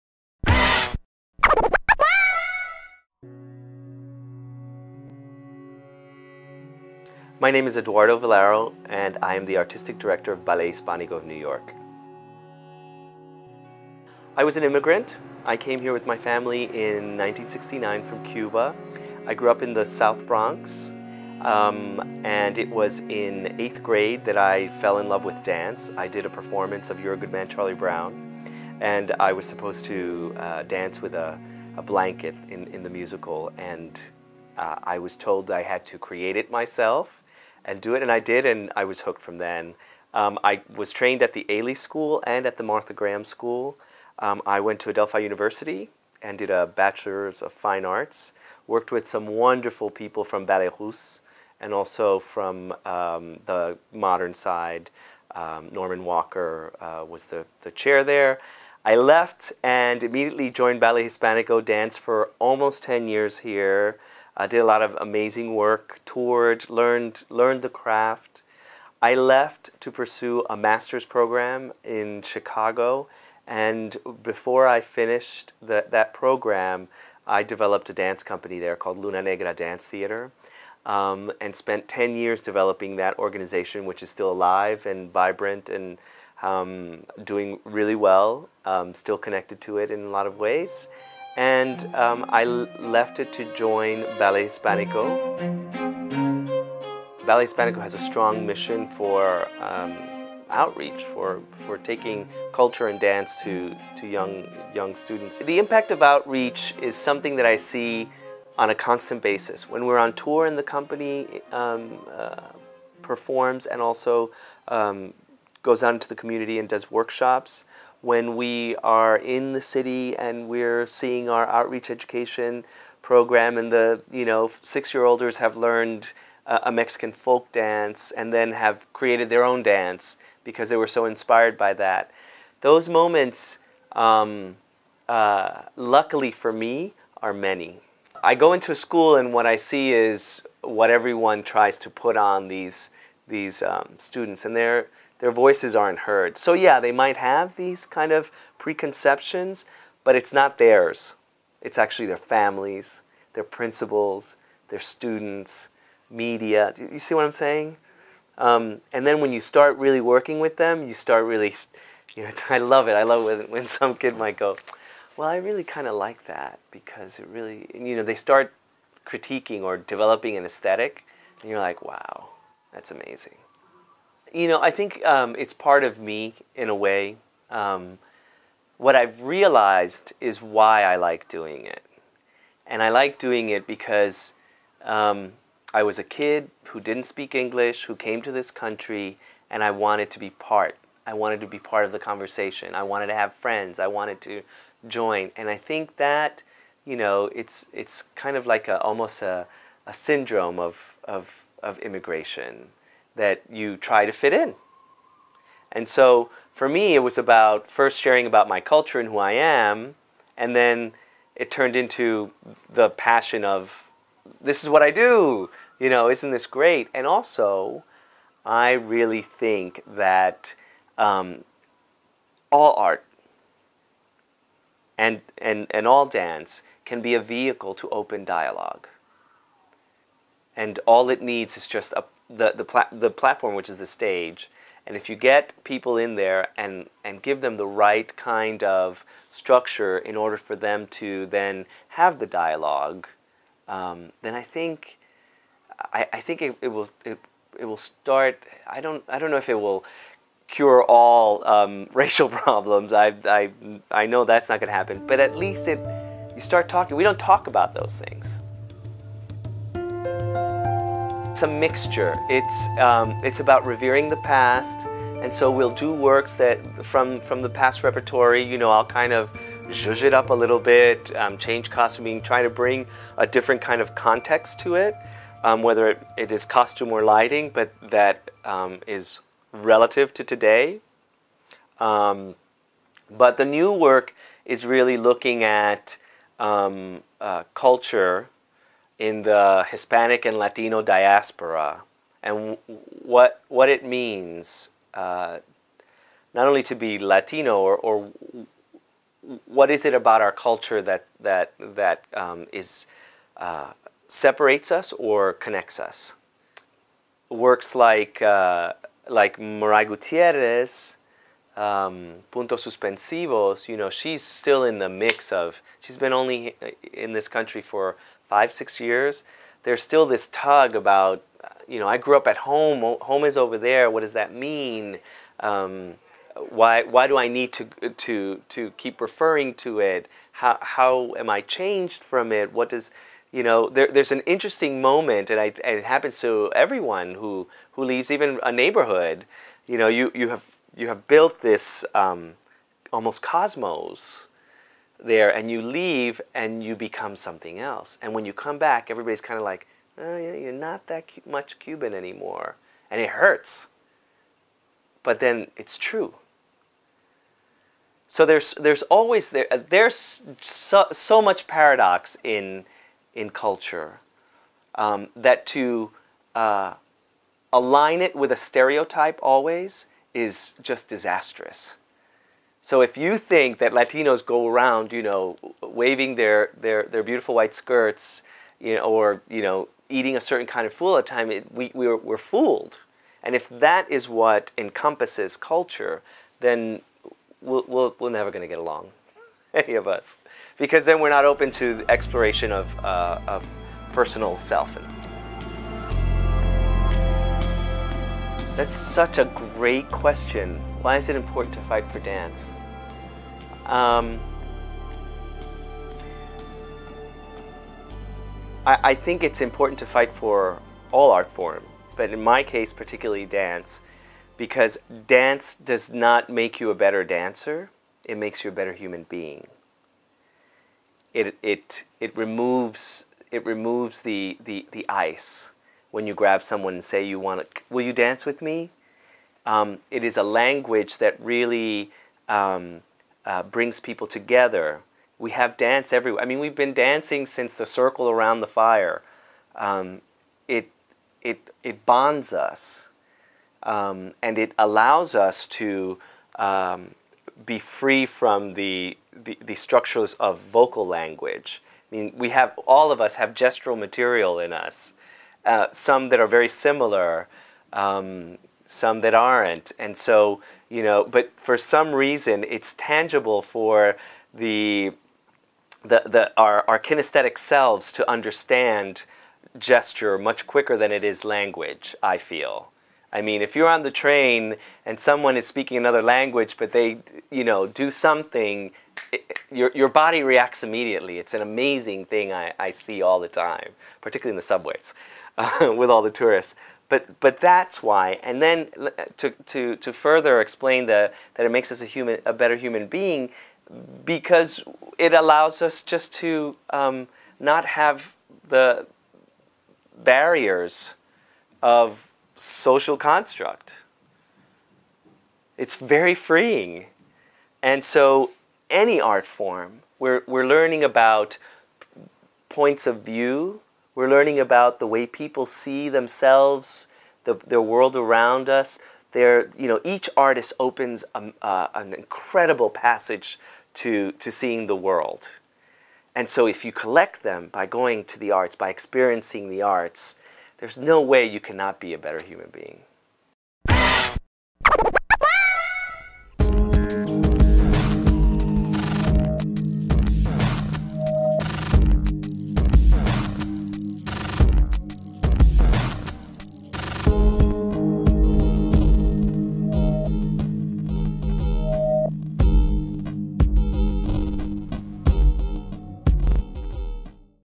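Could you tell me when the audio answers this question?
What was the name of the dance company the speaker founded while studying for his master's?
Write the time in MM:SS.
01:18.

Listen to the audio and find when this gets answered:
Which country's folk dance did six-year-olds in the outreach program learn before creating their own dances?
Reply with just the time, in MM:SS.
02:06.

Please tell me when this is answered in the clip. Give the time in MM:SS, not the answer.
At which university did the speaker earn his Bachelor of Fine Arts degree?
00:44.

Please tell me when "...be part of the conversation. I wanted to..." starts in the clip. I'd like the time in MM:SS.
03:11.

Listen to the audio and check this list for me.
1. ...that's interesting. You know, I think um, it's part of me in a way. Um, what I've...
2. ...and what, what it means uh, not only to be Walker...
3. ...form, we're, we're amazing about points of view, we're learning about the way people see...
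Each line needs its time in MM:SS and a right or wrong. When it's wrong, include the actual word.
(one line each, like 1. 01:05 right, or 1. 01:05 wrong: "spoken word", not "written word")
1. 02:52 wrong: "amazing", not "interesting"
2. 04:52 wrong: "Latino", not "Walker"
3. 08:29 wrong: "learning", not "amazing".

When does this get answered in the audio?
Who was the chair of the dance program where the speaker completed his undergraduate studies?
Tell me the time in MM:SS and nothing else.
00:55.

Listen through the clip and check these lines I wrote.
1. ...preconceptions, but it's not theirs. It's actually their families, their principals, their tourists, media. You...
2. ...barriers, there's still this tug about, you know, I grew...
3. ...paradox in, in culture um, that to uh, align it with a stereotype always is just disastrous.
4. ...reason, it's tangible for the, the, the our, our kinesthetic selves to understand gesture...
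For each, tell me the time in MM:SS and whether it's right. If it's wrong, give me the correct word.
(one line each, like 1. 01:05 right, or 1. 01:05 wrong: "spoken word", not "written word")
1. 02:28 wrong: "students", not "tourists"
2. 05:18 wrong: "years", not "barriers"
3. 06:01 right
4. 07:41 right.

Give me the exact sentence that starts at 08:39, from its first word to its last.
Their, you know, each artist opens a, uh, an incredible passage to, to seeing the world.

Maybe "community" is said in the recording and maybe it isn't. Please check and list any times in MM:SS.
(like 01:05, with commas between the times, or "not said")
01:56.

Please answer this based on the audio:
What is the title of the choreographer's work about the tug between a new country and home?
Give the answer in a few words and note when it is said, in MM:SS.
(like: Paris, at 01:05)
puntos suspensivos, at 05:12.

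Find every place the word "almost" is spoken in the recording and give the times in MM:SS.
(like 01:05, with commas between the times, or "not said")
01:02, 03:18, 05:42.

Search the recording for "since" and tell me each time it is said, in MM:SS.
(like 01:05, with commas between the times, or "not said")
07:17.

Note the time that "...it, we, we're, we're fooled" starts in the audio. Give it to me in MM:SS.
06:21.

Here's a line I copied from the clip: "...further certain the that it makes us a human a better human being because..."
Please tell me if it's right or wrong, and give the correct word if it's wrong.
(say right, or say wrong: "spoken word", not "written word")
wrong: "explain", not "certain".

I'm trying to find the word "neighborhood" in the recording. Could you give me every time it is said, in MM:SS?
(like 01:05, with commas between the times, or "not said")
05:38.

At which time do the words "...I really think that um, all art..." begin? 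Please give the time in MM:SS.
03:38.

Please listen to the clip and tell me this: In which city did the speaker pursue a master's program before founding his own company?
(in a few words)
Chicago.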